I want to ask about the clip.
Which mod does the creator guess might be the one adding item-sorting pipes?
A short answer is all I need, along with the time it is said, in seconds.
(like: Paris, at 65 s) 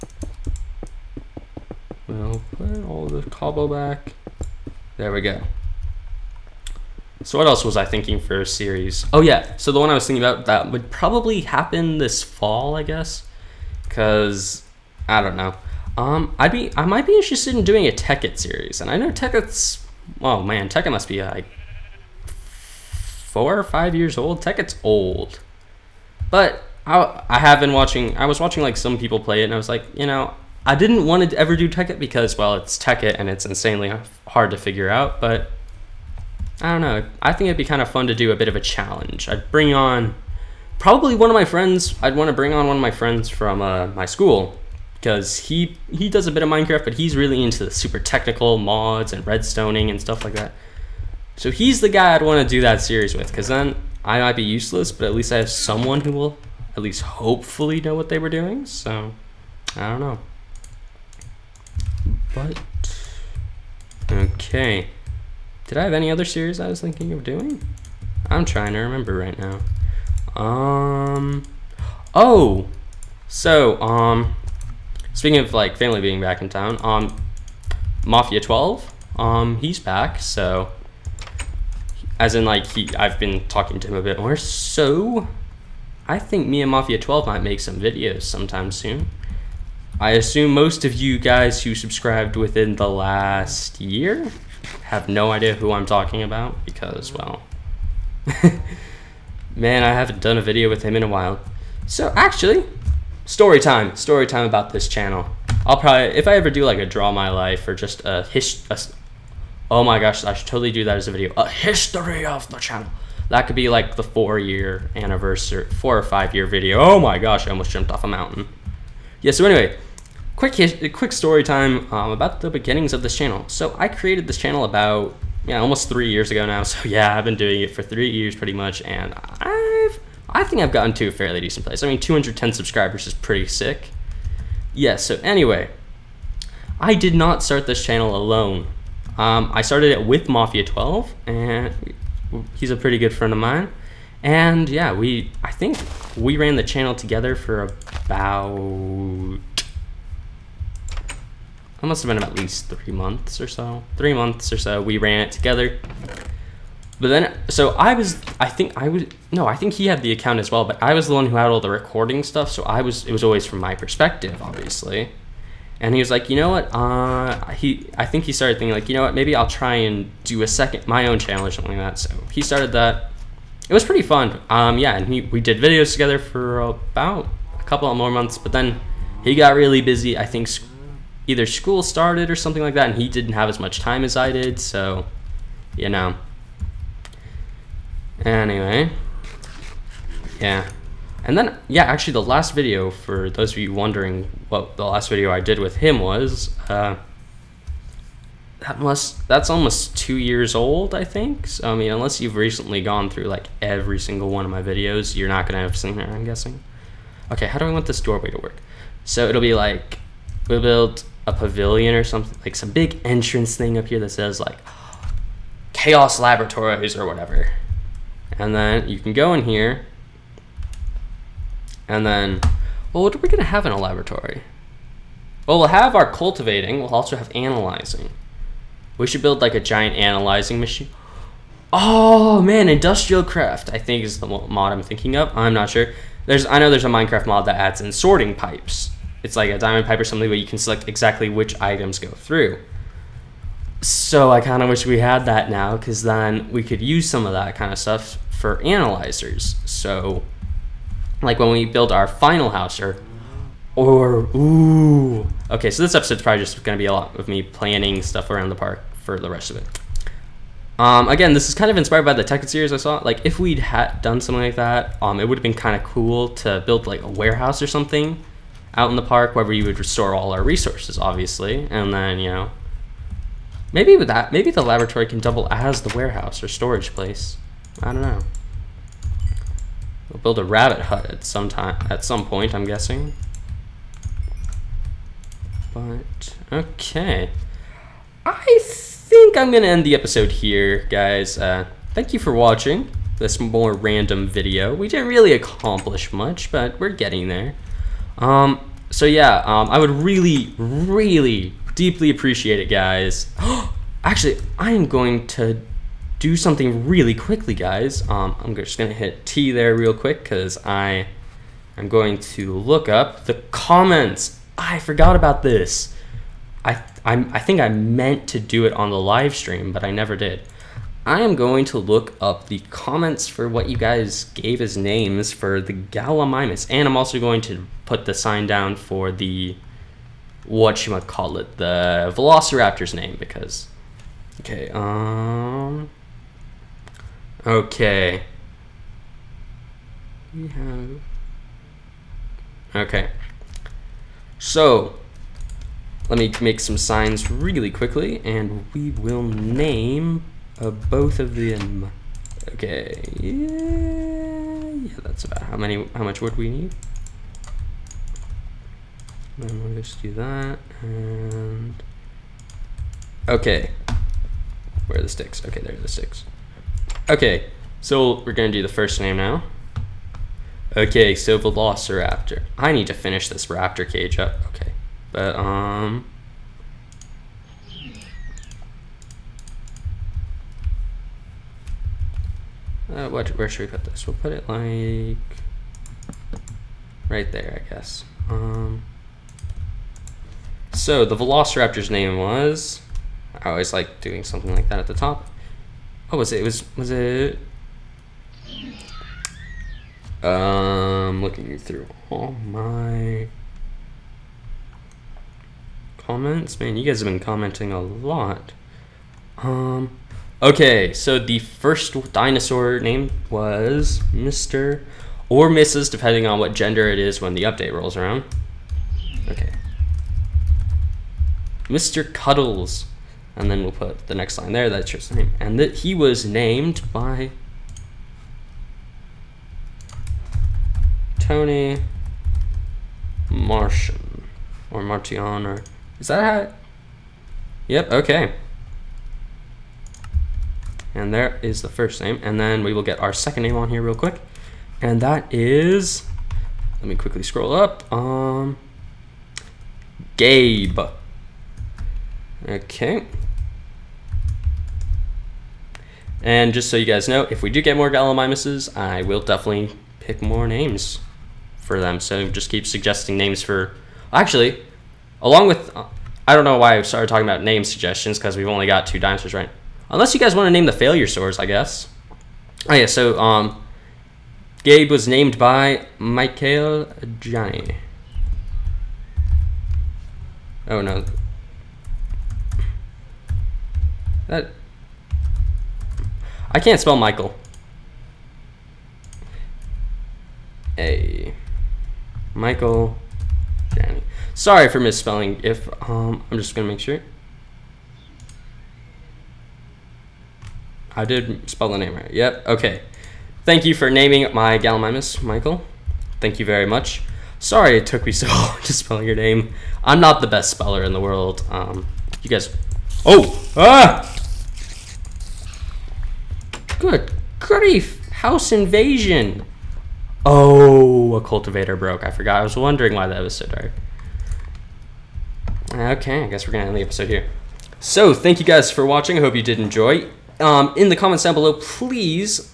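Industrial Craft, at 232 s.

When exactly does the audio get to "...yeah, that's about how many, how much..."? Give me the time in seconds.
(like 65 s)
354 s.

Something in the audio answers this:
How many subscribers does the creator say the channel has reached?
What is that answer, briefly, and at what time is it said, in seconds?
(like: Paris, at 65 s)
210, at 131 s.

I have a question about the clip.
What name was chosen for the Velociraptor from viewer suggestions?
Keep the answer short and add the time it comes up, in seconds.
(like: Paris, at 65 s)
Mr. Cuddles, at 421 s.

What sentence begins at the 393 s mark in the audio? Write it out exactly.
I always like doing something like that at the top.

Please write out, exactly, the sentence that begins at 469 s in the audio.
Unless you guys want to name the failure stores, I guess.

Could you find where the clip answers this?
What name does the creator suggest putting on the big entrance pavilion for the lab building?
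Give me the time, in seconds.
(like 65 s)
215 s.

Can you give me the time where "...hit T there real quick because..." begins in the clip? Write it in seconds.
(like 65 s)
308 s.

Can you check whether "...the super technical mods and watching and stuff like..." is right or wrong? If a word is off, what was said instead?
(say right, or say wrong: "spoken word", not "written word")
wrong: "redstoning", not "watching".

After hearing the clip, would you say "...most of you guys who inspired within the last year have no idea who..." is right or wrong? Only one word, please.
wrong.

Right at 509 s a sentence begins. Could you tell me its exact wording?
I'm not the best speller in the world.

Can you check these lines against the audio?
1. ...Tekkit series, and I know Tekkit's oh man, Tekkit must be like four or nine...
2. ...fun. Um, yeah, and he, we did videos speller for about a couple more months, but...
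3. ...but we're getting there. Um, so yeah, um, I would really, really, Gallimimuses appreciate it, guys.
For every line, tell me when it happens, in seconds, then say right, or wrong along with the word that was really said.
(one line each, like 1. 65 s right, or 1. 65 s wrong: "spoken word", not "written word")
1. 17 s wrong: "five", not "nine"
2. 174 s wrong: "together", not "speller"
3. 296 s wrong: "Deeply", not "Gallimimuses".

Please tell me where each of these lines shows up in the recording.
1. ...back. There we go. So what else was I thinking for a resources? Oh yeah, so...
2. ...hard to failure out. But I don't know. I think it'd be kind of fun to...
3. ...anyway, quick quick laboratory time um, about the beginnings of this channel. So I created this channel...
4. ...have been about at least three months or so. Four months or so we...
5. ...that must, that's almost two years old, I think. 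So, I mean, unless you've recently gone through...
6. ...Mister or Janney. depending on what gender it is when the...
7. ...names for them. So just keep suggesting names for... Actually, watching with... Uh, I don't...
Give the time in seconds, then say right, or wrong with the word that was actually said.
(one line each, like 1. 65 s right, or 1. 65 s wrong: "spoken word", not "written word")
1. 3 s wrong: "series", not "resources"
2. 34 s wrong: "figure", not "failure"
3. 119 s wrong: "story", not "laboratory"
4. 152 s wrong: "Three", not "Four"
5. 198 s right
6. 414 s wrong: "Mrs", not "Janney"
7. 460 s wrong: "along", not "watching".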